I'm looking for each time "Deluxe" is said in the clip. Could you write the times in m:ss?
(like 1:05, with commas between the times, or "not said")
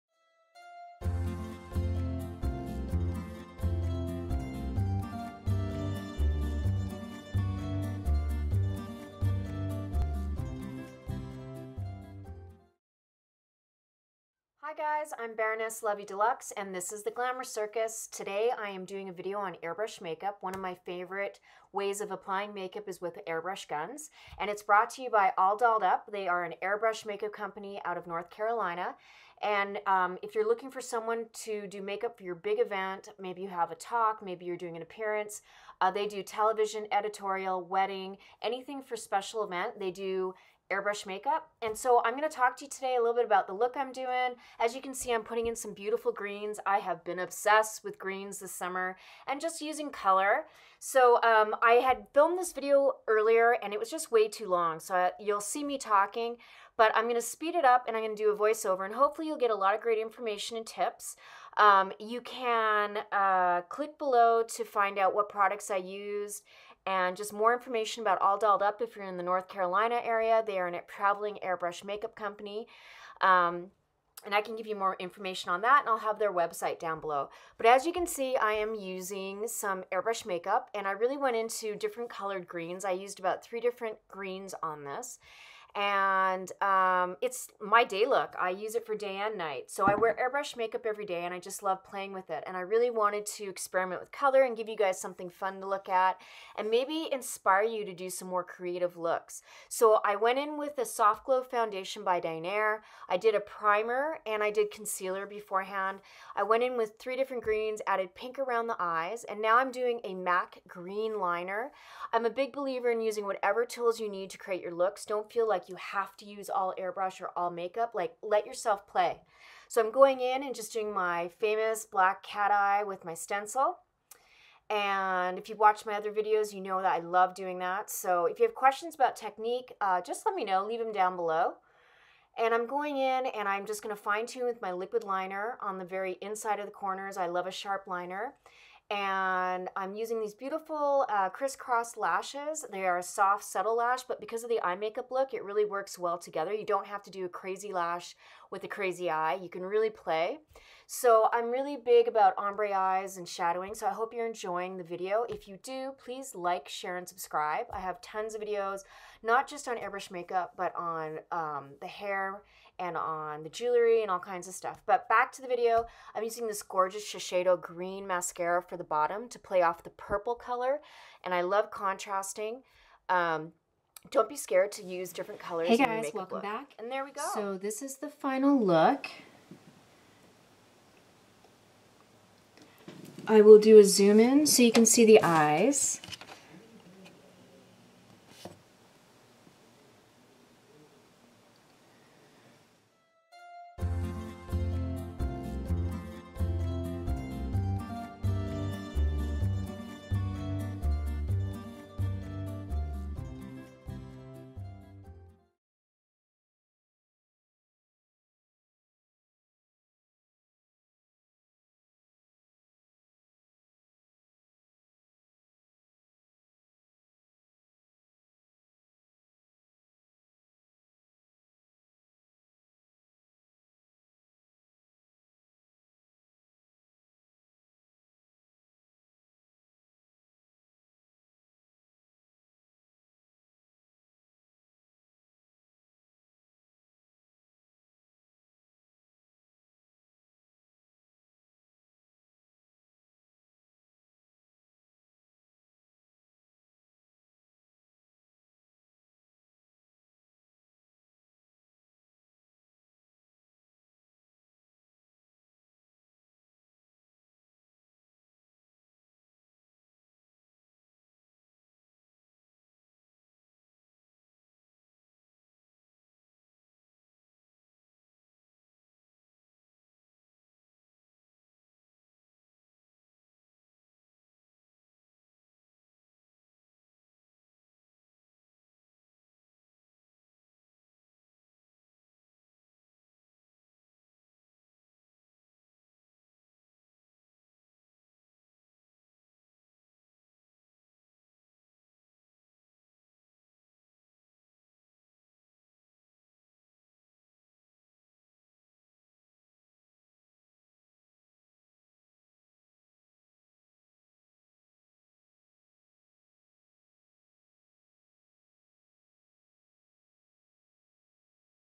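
0:16.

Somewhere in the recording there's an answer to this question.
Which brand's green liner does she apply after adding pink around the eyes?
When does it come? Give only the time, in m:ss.
1:50.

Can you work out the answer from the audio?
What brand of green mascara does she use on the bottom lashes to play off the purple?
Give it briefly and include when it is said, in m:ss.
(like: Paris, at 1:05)
Shiseido, at 2:47.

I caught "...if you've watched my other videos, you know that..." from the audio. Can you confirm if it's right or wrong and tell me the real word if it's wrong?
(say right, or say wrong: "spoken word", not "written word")
right.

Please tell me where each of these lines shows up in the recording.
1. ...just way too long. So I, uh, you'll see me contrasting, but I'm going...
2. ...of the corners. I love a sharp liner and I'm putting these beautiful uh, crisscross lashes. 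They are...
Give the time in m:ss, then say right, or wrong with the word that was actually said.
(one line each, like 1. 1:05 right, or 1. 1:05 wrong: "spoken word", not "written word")
1. 0:53 wrong: "talking", not "contrasting"
2. 2:16 wrong: "using", not "putting".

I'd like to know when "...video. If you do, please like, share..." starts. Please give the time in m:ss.
2:34.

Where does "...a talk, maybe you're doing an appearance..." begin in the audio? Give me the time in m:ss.
0:33.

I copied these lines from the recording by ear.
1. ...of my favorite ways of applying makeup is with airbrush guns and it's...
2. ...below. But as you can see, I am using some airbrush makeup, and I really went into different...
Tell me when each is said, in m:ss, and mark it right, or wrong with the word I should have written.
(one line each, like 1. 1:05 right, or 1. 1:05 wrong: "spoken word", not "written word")
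1. 0:20 right
2. 1:17 right.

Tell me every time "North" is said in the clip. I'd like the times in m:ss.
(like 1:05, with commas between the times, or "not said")
0:28, 1:09.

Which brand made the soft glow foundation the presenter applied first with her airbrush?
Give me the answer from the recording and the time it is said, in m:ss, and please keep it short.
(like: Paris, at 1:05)
Dinair, at 1:42.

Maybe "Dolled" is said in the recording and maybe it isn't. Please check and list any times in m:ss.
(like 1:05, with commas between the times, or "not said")
0:25, 1:08.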